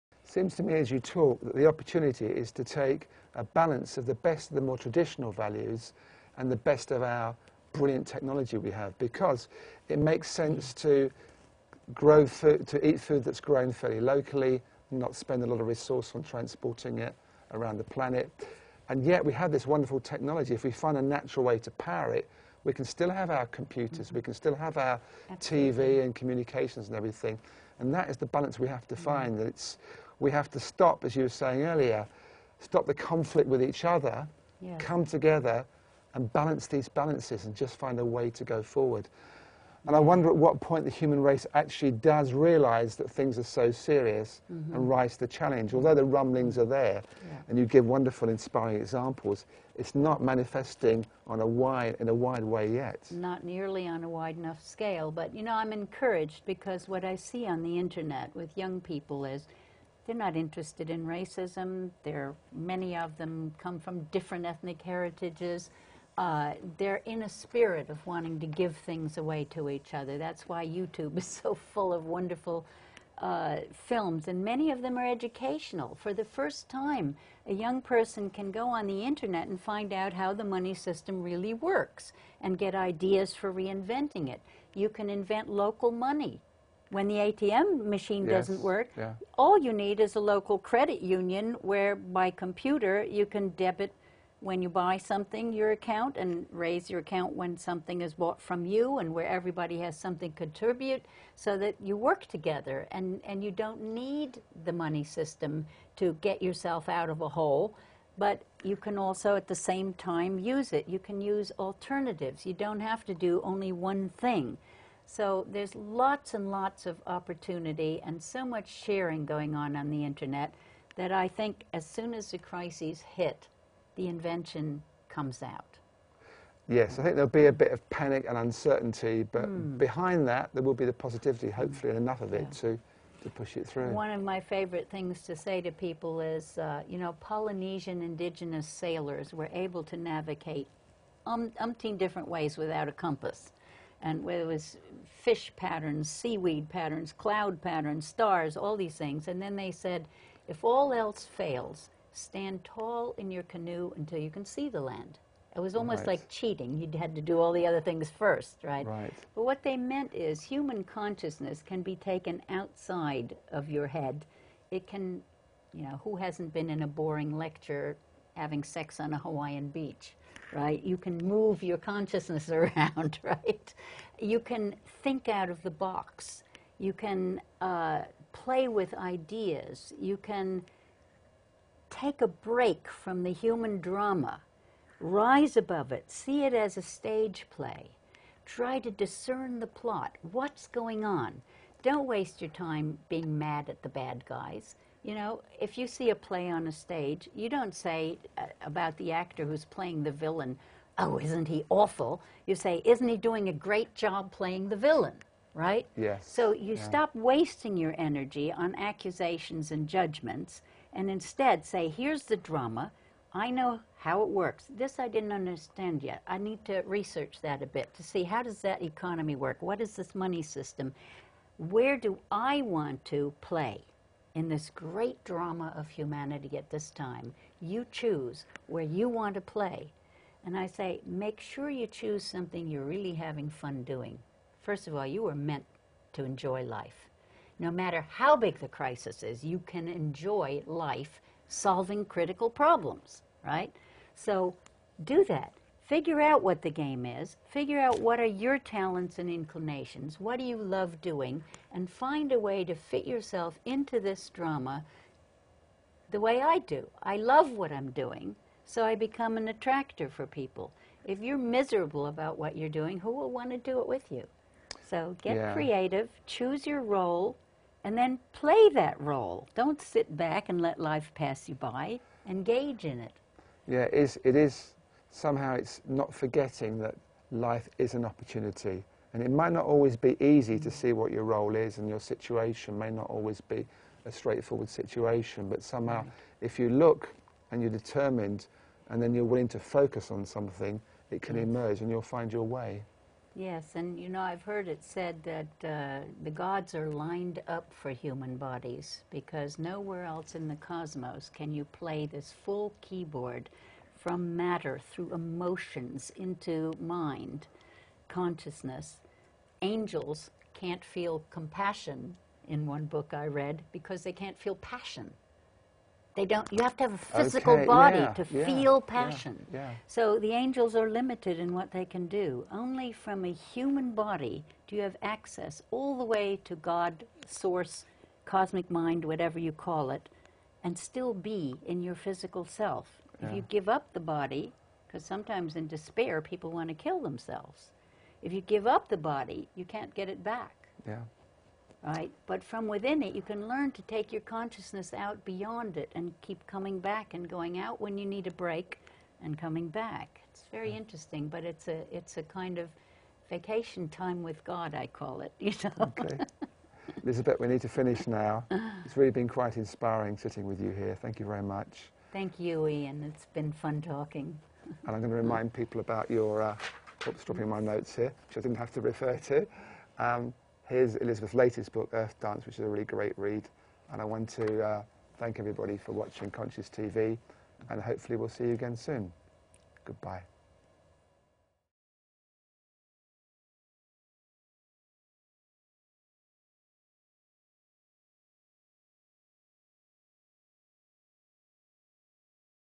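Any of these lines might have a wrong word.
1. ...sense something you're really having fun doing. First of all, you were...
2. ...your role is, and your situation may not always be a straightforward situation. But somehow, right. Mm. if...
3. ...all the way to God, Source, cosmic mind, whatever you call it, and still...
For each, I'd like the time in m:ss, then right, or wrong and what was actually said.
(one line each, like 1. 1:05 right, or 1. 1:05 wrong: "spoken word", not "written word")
1. 3:51 wrong: "choose", not "sense"
2. 4:41 right
3. 5:25 right.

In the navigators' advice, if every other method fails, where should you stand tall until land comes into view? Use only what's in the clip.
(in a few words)
In your canoe.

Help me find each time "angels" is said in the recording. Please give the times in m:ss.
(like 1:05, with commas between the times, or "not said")
5:09, 5:20.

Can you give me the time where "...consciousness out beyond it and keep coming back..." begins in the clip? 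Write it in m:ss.
5:44.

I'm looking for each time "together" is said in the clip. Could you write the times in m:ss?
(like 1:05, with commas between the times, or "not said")
0:35, 1:42.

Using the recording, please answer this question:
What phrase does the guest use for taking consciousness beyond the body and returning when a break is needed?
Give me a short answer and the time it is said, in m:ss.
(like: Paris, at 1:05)
Vacation time with God, at 5:53.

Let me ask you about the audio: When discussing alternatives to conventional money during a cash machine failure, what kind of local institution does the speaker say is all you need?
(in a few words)
Credit union.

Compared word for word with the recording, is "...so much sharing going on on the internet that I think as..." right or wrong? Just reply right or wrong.
right.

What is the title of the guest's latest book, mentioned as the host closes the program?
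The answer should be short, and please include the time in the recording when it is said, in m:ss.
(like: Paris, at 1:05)
Earth Dance, at 6:11.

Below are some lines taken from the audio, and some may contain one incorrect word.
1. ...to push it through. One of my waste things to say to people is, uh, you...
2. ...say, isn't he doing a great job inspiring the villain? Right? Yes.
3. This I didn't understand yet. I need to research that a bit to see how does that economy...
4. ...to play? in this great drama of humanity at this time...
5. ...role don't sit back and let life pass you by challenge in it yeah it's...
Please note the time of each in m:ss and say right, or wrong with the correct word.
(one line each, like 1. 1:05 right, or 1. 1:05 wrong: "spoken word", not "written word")
1. 2:13 wrong: "favorite", not "waste"
2. 3:22 wrong: "playing", not "inspiring"
3. 3:34 right
4. 3:43 right
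5. 4:29 wrong: "engage", not "challenge".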